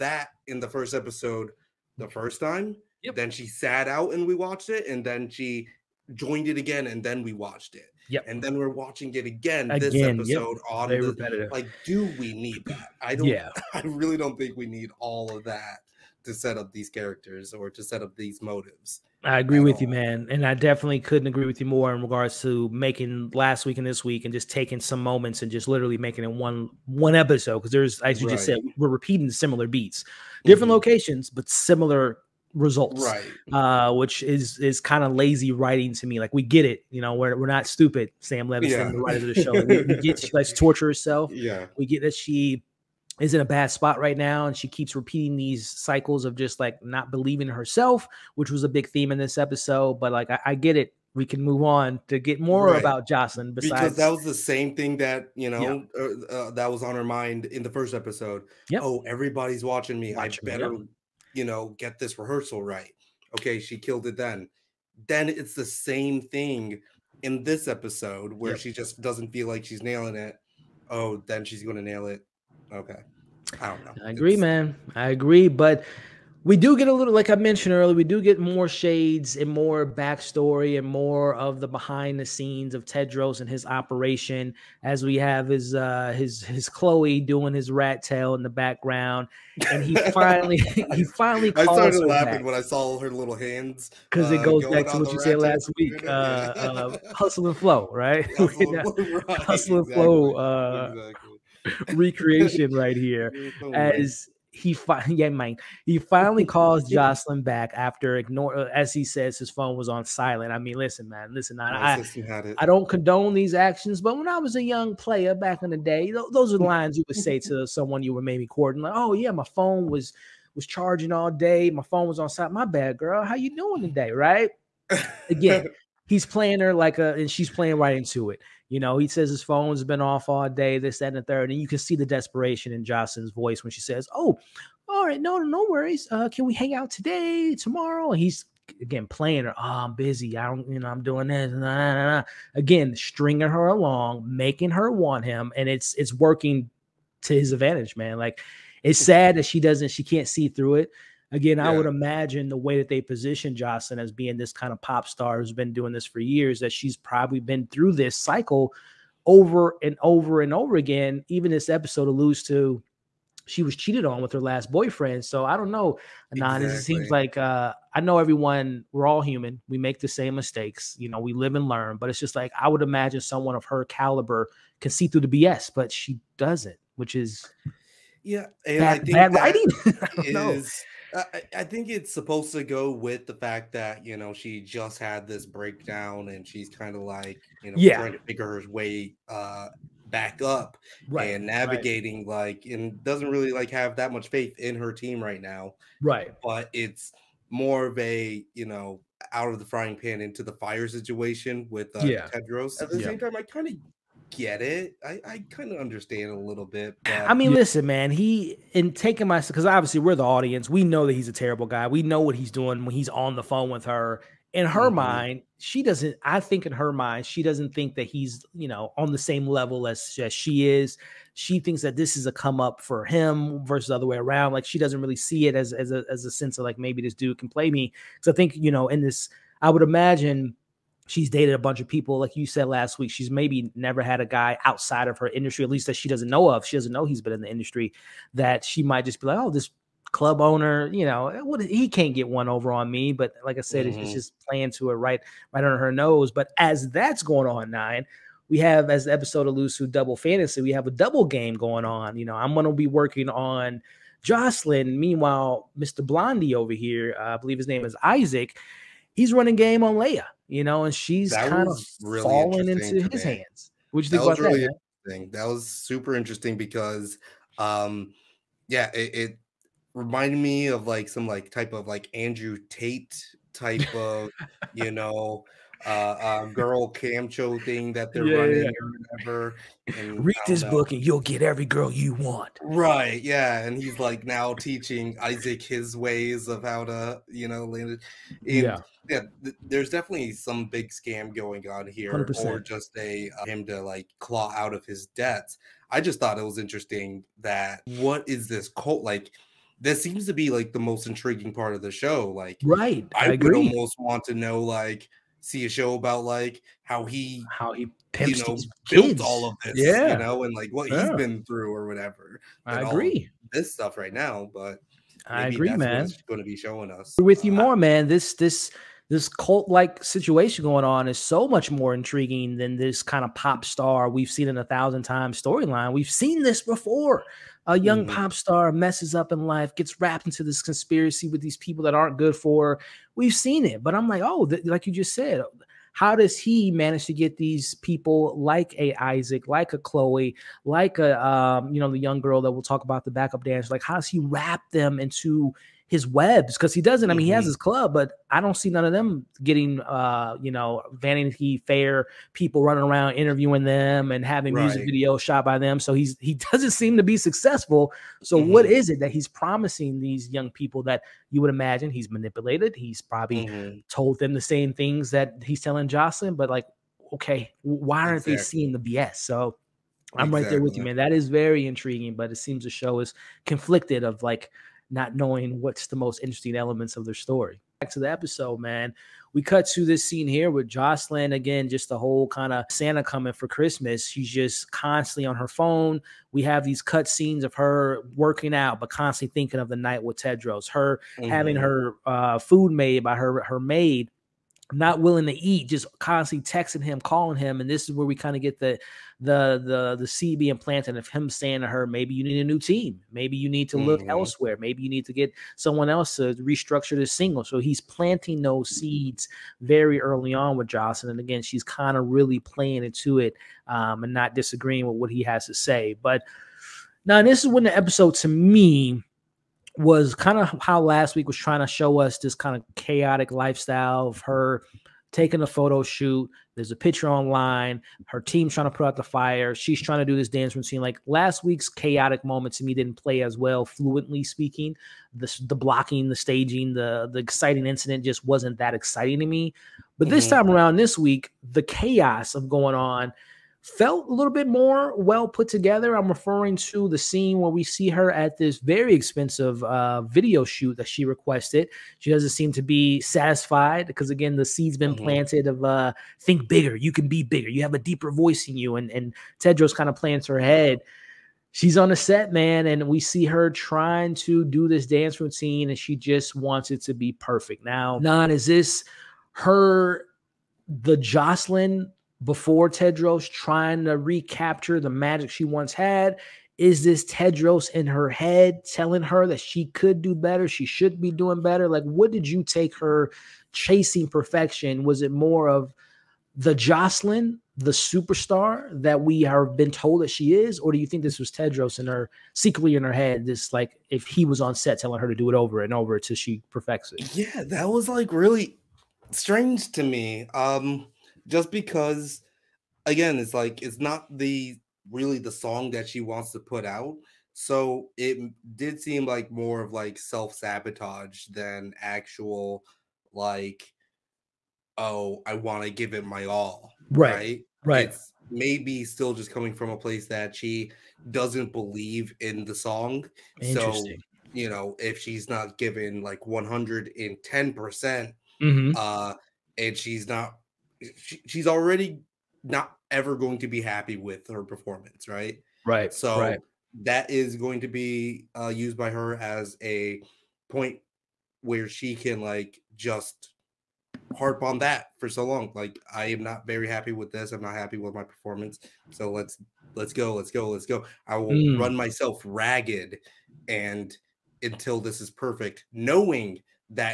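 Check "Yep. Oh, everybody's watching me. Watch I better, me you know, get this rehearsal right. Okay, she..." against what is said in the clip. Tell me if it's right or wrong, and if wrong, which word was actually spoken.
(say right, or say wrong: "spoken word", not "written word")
right.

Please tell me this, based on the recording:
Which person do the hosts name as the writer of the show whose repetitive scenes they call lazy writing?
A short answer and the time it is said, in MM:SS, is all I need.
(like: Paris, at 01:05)
Sam Levinson, at 00:38.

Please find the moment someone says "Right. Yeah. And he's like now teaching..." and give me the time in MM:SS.
04:42.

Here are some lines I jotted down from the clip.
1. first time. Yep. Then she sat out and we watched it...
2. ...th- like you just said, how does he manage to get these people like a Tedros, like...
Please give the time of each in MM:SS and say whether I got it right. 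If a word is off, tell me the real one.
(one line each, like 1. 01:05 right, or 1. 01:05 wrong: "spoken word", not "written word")
1. 00:02 right
2. 05:34 wrong: "Isaac", not "Tedros".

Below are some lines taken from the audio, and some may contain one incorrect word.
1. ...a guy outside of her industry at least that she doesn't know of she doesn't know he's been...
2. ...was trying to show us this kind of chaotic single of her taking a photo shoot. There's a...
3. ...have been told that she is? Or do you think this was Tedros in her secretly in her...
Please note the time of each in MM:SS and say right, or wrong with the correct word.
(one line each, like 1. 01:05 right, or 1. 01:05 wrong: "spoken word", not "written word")
1. 03:54 right
2. 07:01 wrong: "lifestyle", not "single"
3. 08:09 right.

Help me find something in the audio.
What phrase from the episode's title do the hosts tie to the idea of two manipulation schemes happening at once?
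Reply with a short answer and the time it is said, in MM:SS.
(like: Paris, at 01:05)
Double fantasy, at 04:09.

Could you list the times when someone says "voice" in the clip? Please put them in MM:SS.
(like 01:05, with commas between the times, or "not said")
02:13, 07:38.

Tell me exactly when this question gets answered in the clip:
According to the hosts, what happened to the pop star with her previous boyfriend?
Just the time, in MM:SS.
02:43.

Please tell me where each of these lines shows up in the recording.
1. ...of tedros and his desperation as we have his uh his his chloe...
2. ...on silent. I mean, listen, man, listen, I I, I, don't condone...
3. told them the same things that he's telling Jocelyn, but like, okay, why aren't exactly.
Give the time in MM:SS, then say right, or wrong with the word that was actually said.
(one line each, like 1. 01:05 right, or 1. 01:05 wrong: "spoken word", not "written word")
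1. 01:22 wrong: "operation", not "desperation"
2. 01:49 right
3. 06:03 right.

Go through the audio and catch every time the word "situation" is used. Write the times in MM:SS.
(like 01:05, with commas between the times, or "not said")
03:20, 05:20.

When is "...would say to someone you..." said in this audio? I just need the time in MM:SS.
01:57.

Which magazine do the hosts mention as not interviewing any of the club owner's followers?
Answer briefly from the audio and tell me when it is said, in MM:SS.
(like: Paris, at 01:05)
Vanity Fair, at 05:50.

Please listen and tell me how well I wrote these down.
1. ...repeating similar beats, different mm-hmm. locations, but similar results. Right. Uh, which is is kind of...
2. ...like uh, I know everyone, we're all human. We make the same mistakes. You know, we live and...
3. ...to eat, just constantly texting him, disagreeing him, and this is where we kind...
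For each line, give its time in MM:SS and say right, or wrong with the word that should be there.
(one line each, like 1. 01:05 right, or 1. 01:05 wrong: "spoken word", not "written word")
1. 00:28 right
2. 02:47 right
3. 06:35 wrong: "calling", not "disagreeing".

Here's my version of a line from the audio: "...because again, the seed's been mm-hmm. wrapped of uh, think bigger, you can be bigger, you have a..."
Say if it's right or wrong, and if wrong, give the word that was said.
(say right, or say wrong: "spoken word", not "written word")
wrong: "planted", not "wrapped".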